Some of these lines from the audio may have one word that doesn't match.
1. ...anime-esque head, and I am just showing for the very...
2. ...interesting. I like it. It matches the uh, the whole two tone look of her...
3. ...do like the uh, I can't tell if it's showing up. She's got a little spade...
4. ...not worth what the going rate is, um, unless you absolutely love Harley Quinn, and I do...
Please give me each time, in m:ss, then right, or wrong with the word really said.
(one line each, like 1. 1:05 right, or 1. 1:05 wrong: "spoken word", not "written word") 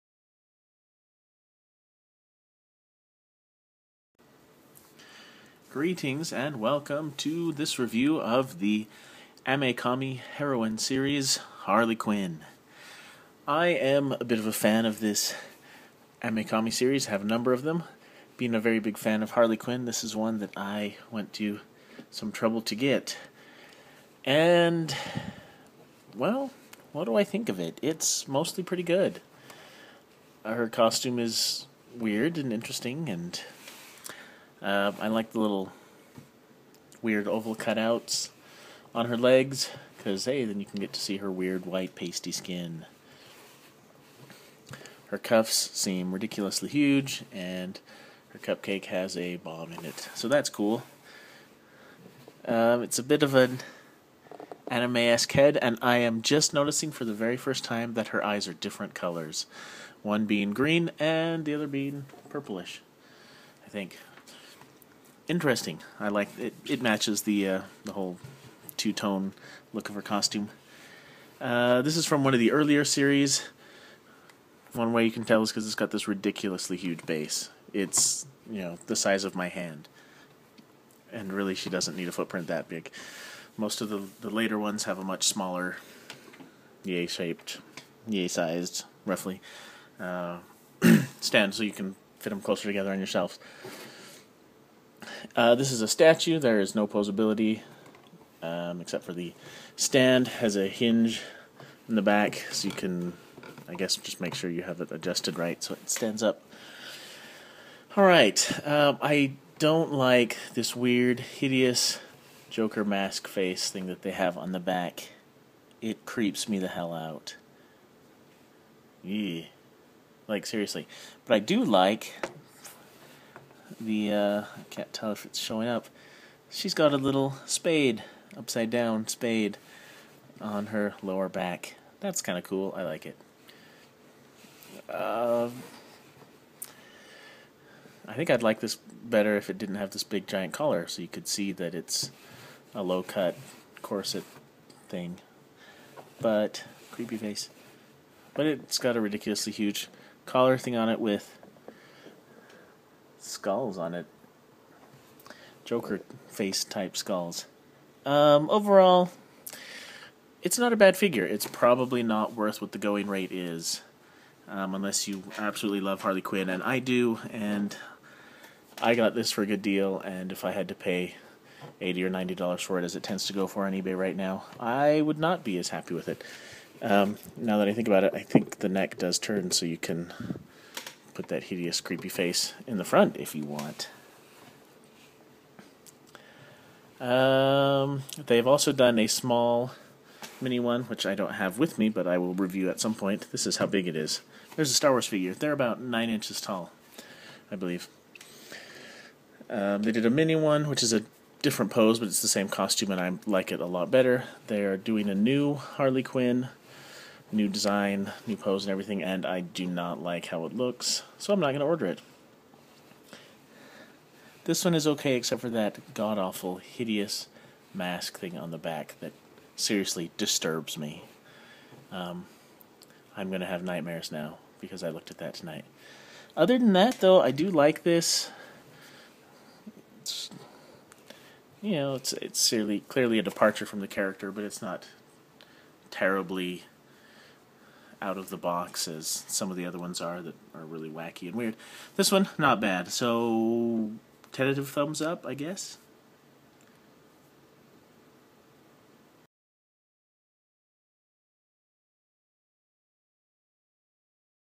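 1. 0:54 wrong: "noticing", not "showing"
2. 1:05 right
3. 2:01 right
4. 2:42 right.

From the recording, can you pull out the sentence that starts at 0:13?
I am a bit of a fan of this Ame-Comi series, I have a number of them.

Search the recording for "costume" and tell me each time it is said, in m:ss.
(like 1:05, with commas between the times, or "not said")
0:30, 1:10, 3:22.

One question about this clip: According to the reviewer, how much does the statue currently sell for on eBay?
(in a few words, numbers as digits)
$80 to $90.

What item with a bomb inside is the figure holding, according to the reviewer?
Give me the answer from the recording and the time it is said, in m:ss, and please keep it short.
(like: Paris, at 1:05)
Cupcake, at 0:48.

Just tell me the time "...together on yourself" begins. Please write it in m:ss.
1:32.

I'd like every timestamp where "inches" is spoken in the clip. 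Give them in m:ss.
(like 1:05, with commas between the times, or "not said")
3:16.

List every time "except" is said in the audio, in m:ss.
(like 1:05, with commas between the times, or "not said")
1:38, 3:35.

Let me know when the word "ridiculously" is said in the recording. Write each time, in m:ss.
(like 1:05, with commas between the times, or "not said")
0:46, 1:16, 2:29.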